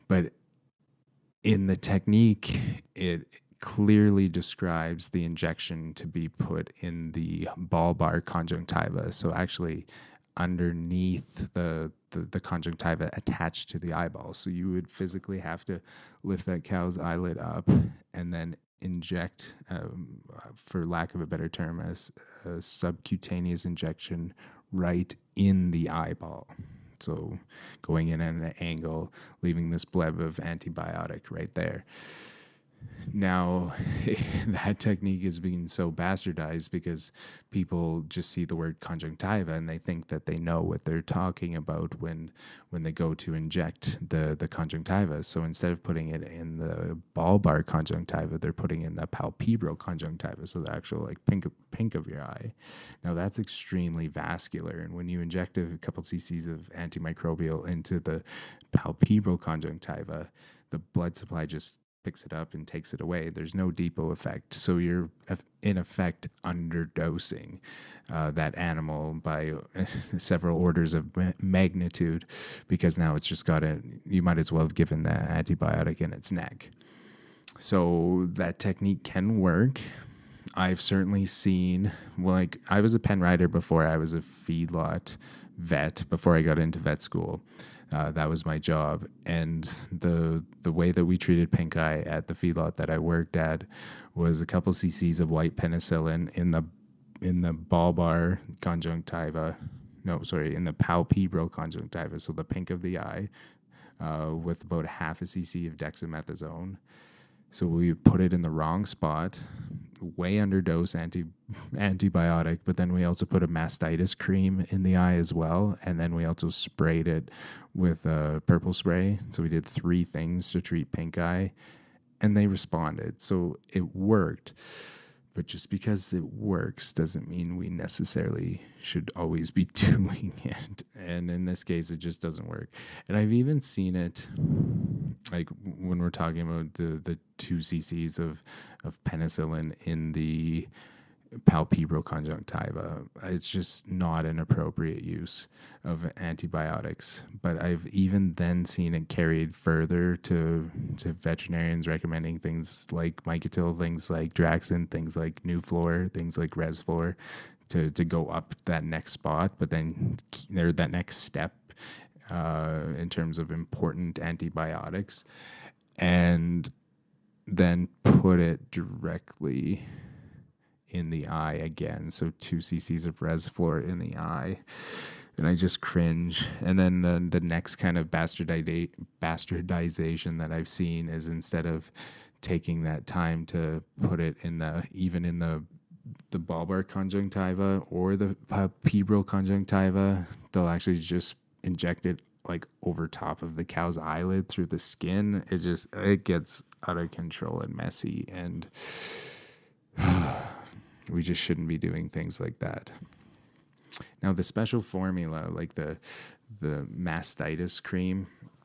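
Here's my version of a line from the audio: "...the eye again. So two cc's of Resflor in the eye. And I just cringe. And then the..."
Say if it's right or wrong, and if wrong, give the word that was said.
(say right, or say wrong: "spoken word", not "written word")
right.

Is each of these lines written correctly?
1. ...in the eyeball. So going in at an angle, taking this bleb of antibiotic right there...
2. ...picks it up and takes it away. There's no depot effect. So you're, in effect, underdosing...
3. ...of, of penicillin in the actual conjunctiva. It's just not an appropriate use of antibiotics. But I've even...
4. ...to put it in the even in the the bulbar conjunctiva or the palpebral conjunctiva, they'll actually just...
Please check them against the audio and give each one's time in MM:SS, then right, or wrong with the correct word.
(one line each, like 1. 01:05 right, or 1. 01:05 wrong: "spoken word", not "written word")
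1. 00:25 wrong: "leaving", not "taking"
2. 01:02 right
3. 02:18 wrong: "palpebral", not "actual"
4. 03:03 right.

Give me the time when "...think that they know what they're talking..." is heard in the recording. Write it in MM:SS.
00:39.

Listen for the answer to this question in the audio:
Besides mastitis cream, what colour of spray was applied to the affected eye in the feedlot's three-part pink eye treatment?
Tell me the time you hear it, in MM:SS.
01:58.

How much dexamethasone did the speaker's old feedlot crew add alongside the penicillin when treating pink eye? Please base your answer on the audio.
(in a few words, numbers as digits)
half a cc.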